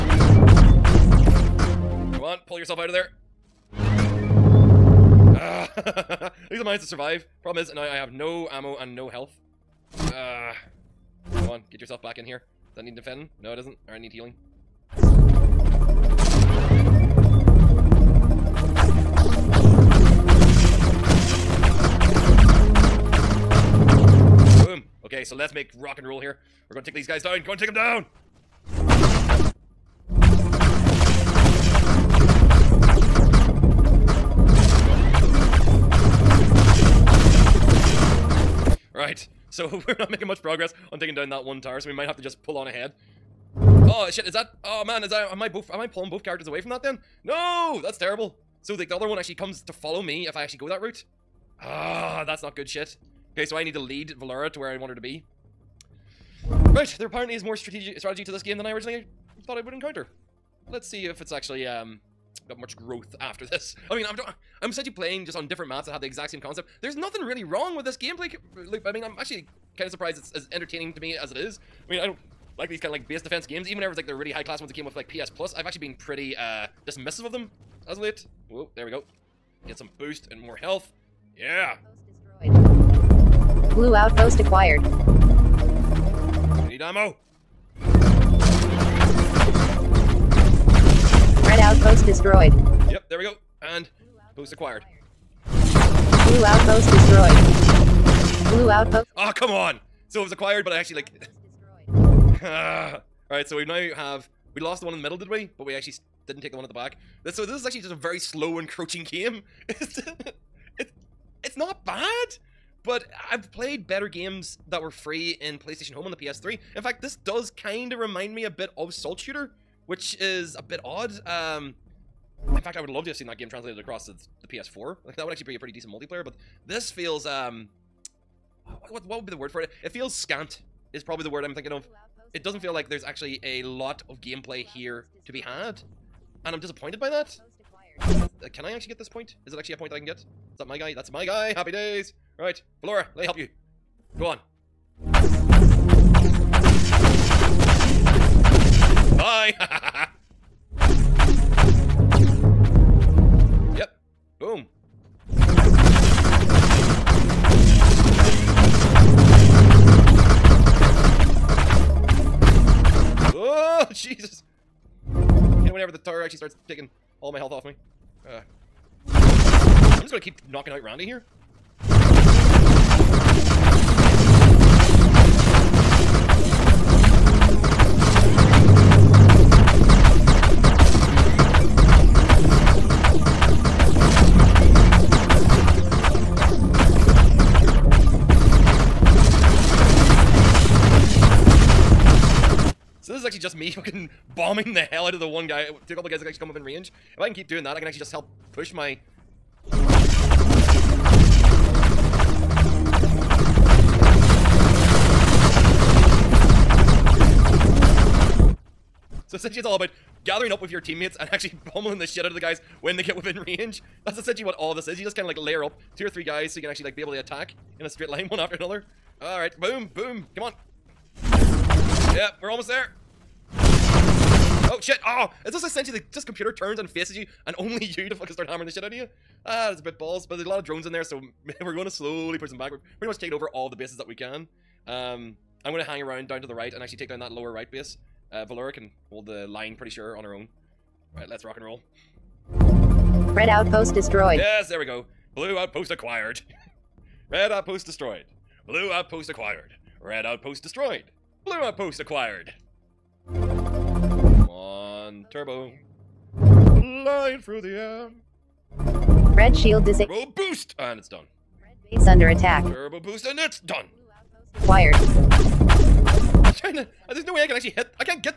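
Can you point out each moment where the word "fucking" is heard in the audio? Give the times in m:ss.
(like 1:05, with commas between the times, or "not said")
3:13, 3:48.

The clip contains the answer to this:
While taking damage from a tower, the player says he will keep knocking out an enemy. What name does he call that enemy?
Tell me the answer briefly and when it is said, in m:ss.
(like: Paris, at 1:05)
Randy, at 2:50.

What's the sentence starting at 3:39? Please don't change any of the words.
All right, boom, boom, come on.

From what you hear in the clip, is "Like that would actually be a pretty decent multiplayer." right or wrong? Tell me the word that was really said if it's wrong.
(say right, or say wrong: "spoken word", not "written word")
right.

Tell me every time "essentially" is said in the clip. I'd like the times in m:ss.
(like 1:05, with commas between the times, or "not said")
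1:04, 3:29, 3:34, 3:45.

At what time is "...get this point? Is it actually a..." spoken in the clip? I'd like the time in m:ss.
2:18.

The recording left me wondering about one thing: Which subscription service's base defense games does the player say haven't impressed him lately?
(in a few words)
PS Plus.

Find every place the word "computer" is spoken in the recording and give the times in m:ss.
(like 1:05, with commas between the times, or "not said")
3:46.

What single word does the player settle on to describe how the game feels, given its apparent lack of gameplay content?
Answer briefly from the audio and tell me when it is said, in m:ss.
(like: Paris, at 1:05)
scant, at 2:10.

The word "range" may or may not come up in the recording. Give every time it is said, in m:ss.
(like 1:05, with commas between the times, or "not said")
3:16, 3:33.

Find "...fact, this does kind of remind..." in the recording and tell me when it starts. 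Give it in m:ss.
1:56.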